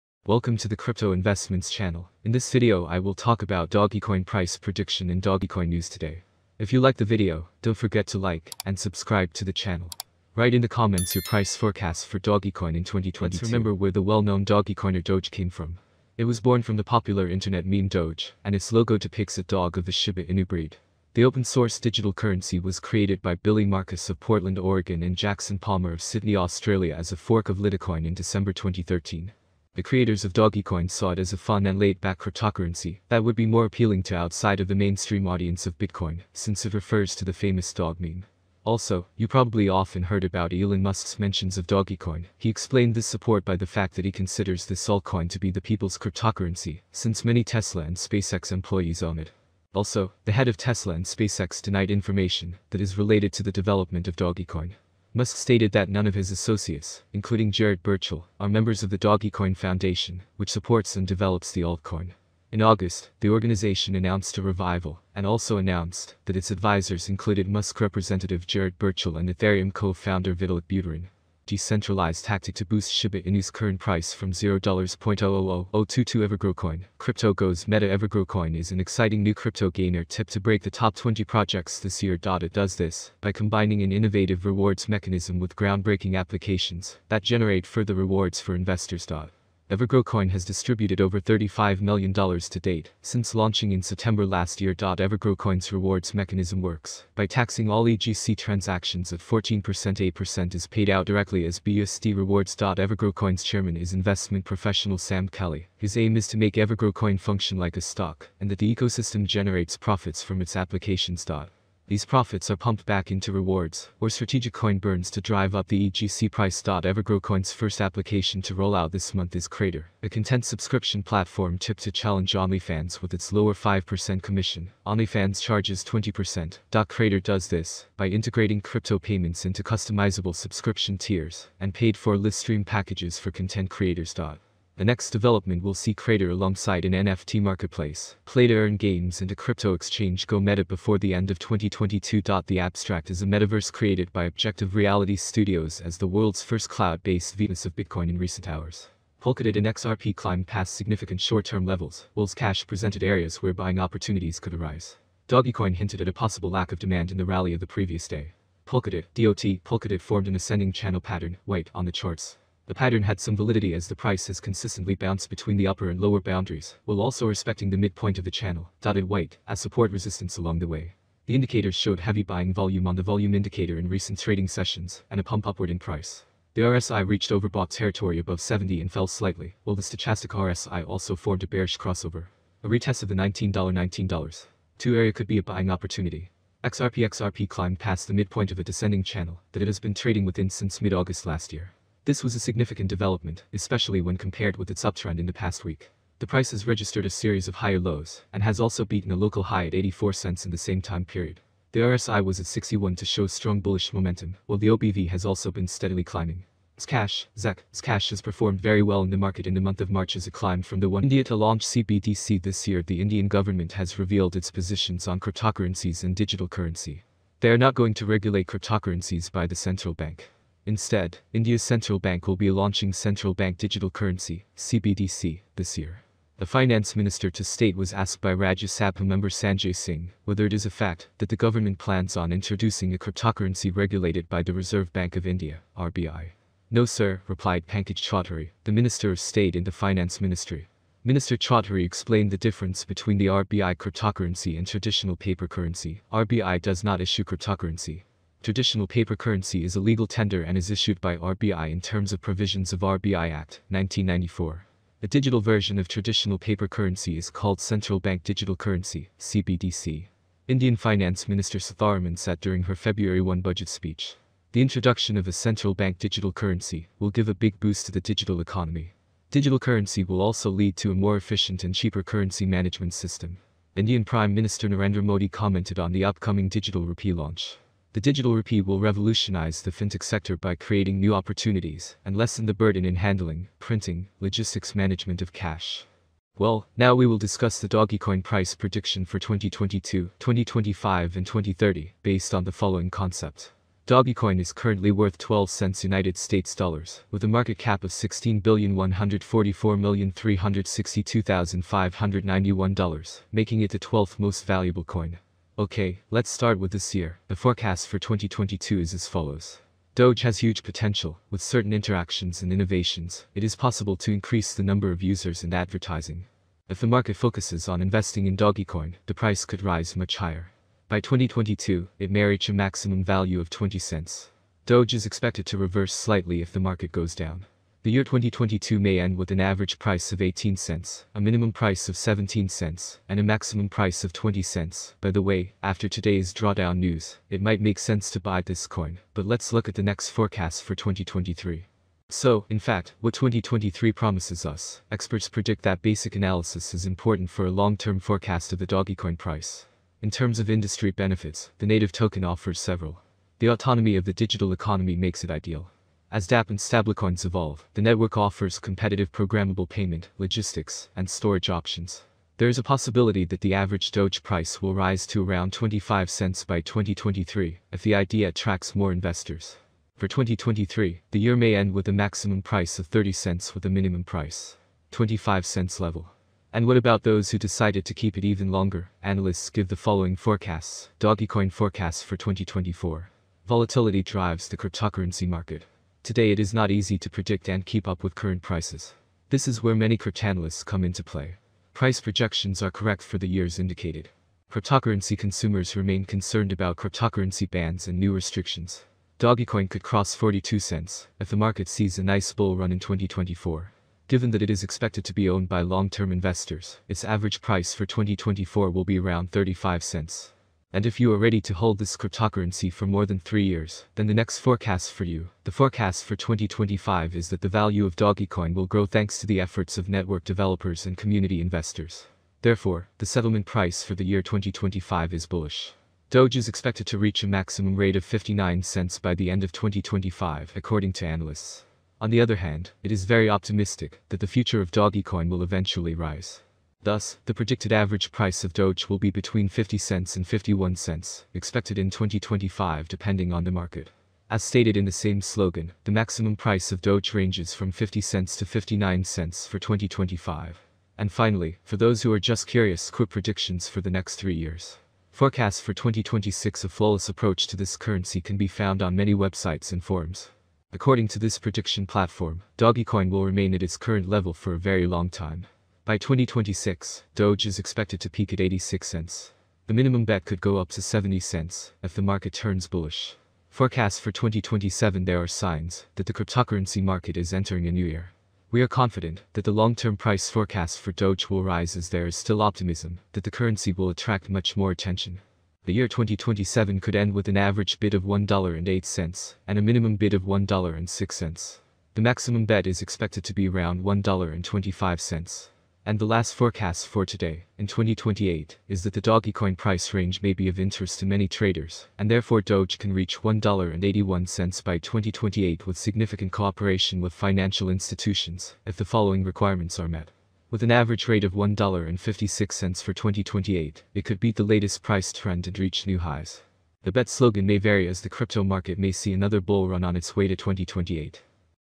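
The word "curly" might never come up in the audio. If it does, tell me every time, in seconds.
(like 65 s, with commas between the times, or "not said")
not said.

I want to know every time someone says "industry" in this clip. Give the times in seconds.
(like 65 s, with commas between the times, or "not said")
350 s.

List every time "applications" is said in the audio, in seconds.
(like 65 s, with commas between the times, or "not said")
86 s, 110 s, 117 s.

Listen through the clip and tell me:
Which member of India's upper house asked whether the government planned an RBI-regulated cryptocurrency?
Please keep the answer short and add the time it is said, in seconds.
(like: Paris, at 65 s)
Sanjay Singh, at 229 s.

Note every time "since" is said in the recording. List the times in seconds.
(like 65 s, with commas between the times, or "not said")
36 s, 46 s, 93 s, 190 s.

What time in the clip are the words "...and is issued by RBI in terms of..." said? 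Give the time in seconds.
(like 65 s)
250 s.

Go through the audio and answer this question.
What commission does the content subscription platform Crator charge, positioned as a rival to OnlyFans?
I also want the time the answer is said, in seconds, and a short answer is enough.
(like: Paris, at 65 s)
5%, at 123 s.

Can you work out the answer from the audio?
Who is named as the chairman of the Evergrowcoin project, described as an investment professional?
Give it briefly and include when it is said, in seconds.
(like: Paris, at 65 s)
Sam Kelly, at 104 s.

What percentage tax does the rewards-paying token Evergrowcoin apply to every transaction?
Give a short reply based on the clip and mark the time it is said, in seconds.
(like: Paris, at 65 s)
14%, at 99 s.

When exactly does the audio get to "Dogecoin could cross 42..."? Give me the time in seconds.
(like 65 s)
399 s.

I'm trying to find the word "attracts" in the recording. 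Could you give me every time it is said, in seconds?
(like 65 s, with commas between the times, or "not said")
368 s, 483 s.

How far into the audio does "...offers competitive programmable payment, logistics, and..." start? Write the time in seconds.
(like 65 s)
358 s.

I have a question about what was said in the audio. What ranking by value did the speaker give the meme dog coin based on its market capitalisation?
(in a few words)
12th.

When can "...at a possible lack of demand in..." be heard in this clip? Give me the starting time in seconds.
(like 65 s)
156 s.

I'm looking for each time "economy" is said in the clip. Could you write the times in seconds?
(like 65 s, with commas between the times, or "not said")
268 s, 354 s.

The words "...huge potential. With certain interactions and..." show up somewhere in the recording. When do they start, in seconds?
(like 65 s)
310 s.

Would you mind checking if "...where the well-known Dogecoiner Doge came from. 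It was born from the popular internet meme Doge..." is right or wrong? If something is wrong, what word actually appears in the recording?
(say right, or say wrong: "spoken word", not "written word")
right.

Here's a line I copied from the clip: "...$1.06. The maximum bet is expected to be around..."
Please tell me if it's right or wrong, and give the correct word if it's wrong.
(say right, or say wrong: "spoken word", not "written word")
right.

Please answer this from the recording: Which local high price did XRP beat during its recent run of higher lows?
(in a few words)
84 cents.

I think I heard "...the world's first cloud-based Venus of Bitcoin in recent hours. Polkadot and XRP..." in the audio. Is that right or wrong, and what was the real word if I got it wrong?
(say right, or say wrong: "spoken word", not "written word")
right.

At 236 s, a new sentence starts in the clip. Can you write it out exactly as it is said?
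No sir, replied Pankaj Chaudhary, the Minister of State in the Finance Ministry.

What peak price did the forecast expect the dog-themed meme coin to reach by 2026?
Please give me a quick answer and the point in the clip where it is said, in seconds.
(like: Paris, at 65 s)
86 cents, at 468 s.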